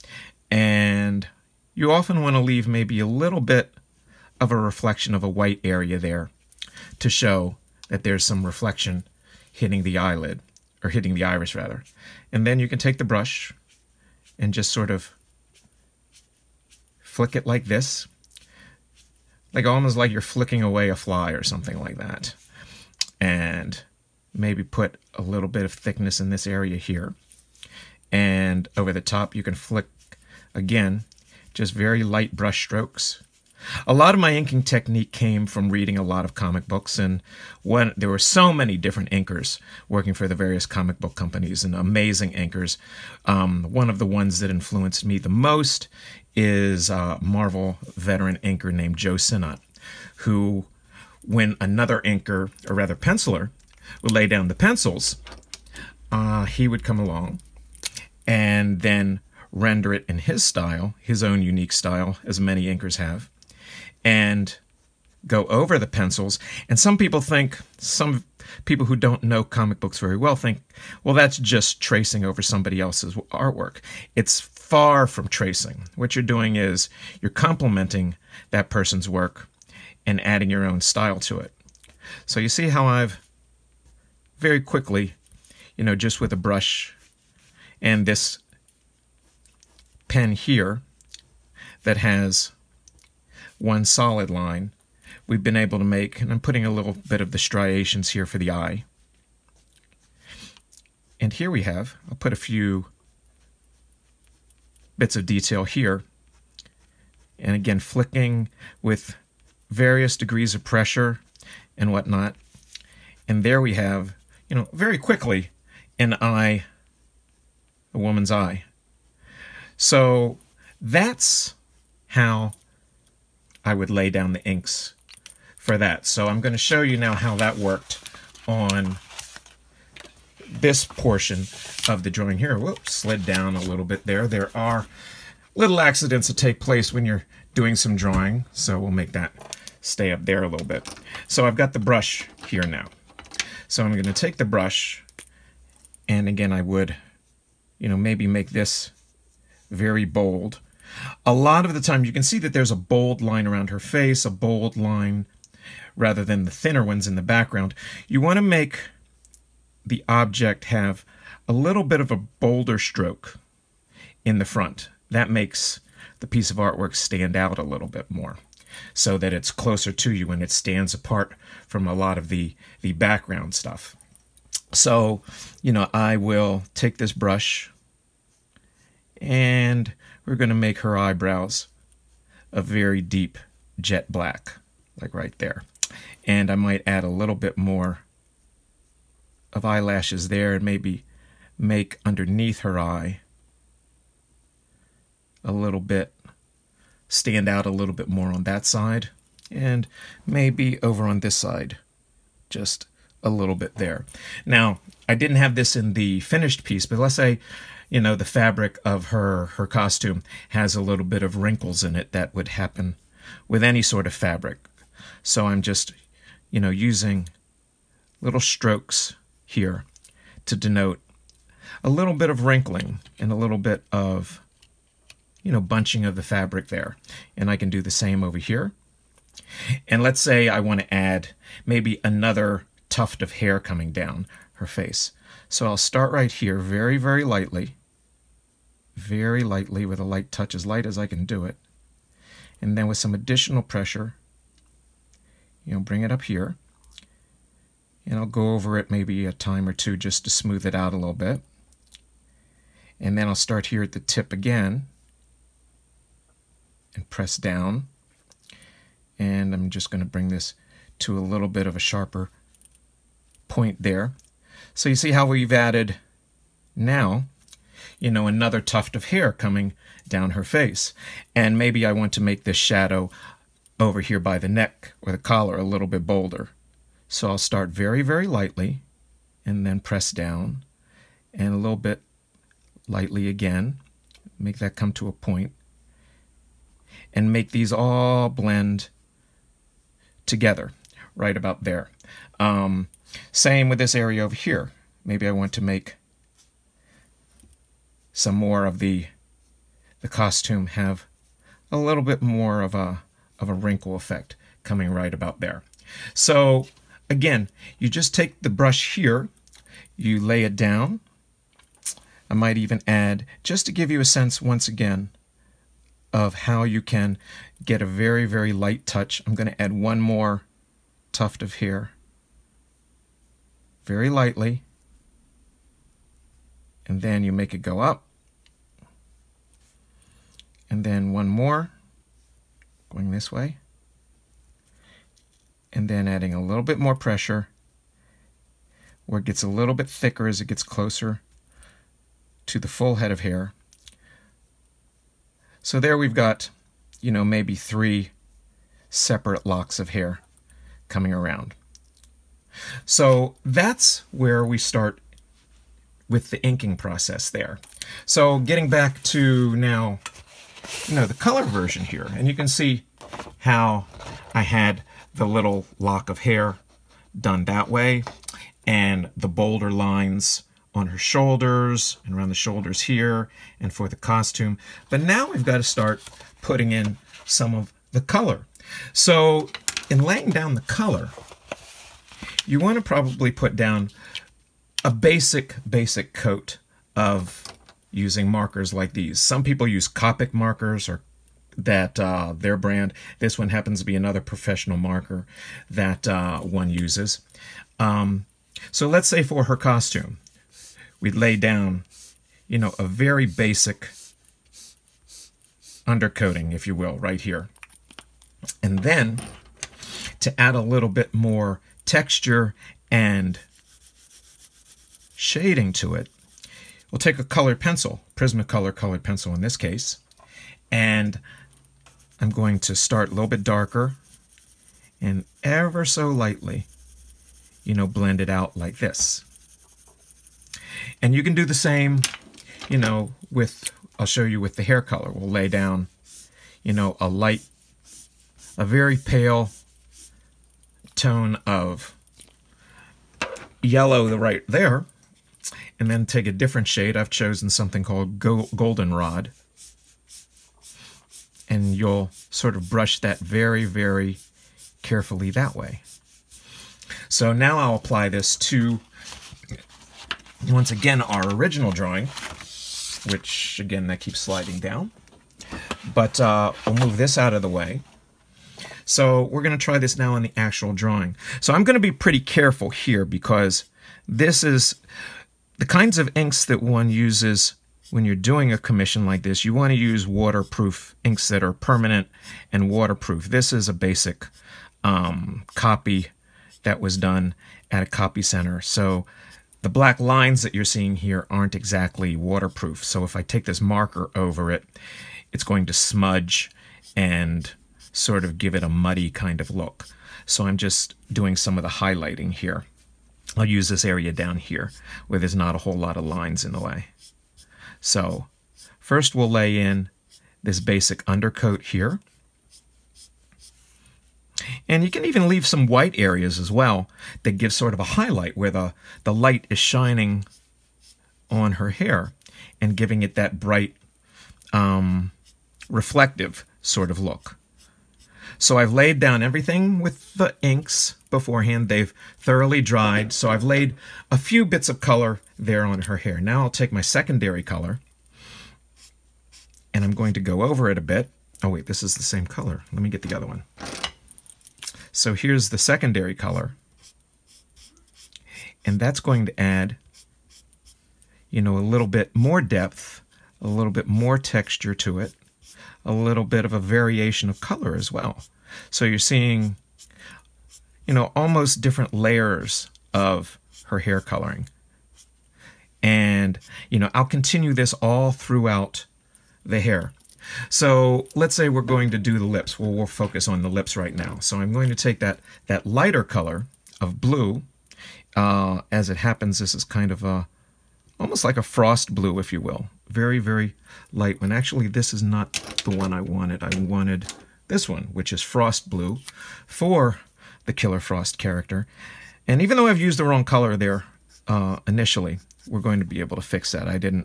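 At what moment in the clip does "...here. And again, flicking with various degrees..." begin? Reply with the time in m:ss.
1:45.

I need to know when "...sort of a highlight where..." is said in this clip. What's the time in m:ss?
8:37.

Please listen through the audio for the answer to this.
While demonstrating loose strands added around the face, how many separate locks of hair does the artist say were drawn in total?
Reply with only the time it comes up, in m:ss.
5:47.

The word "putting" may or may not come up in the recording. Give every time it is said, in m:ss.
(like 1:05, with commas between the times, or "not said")
1:36, 6:16.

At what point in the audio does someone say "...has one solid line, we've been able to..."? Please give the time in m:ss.
1:31.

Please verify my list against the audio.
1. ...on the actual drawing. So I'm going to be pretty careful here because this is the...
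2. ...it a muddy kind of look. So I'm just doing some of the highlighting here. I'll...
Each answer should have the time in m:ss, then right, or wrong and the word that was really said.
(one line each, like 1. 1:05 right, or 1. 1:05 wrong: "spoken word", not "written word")
1. 7:50 right
2. 8:18 right.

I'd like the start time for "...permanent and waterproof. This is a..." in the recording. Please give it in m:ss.
8:01.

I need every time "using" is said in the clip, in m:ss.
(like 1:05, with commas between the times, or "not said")
3:36, 6:27.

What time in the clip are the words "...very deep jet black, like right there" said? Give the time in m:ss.
3:02.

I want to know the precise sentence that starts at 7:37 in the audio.
So now I'll apply this to, once again, our original drawing, which, again, that keeps sliding down.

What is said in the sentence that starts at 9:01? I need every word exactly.
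Oh wait, this is the same color.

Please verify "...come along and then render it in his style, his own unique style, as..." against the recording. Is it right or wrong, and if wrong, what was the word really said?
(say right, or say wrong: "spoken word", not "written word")
right.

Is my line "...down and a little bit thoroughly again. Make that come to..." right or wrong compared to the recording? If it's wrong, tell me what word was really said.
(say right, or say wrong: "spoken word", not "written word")
wrong: "lightly", not "thoroughly".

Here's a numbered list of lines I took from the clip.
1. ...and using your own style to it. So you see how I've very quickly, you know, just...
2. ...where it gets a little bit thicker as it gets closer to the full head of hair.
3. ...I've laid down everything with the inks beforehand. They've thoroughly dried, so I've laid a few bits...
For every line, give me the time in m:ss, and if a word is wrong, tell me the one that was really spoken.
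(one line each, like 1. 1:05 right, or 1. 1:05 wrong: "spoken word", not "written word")
1. 1:20 wrong: "adding", not "using"
2. 5:39 right
3. 8:48 right.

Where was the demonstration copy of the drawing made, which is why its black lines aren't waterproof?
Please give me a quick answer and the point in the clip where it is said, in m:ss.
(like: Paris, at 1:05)
a copy center, at 8:07.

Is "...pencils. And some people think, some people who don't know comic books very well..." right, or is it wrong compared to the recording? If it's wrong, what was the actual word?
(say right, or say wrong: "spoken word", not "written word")
right.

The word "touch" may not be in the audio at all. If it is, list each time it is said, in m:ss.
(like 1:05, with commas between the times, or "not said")
4:00, 5:18.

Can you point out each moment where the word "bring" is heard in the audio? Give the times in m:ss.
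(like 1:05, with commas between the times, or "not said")
4:05, 4:20.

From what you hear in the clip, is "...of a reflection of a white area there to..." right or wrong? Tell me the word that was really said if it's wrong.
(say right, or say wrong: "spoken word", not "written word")
right.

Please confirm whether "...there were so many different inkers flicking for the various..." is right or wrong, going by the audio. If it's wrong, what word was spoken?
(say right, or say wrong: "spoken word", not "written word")
wrong: "working", not "flicking".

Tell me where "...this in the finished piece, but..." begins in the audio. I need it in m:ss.
3:25.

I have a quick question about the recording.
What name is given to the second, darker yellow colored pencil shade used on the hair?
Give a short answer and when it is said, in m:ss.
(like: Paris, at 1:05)
goldenrod, at 7:28.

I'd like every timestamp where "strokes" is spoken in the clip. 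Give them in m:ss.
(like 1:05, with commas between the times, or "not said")
0:32, 2:42, 3:38.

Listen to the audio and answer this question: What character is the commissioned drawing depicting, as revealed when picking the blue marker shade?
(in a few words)
Killer Frost.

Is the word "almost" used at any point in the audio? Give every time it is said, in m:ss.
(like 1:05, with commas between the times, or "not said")
0:19, 9:21, 9:40.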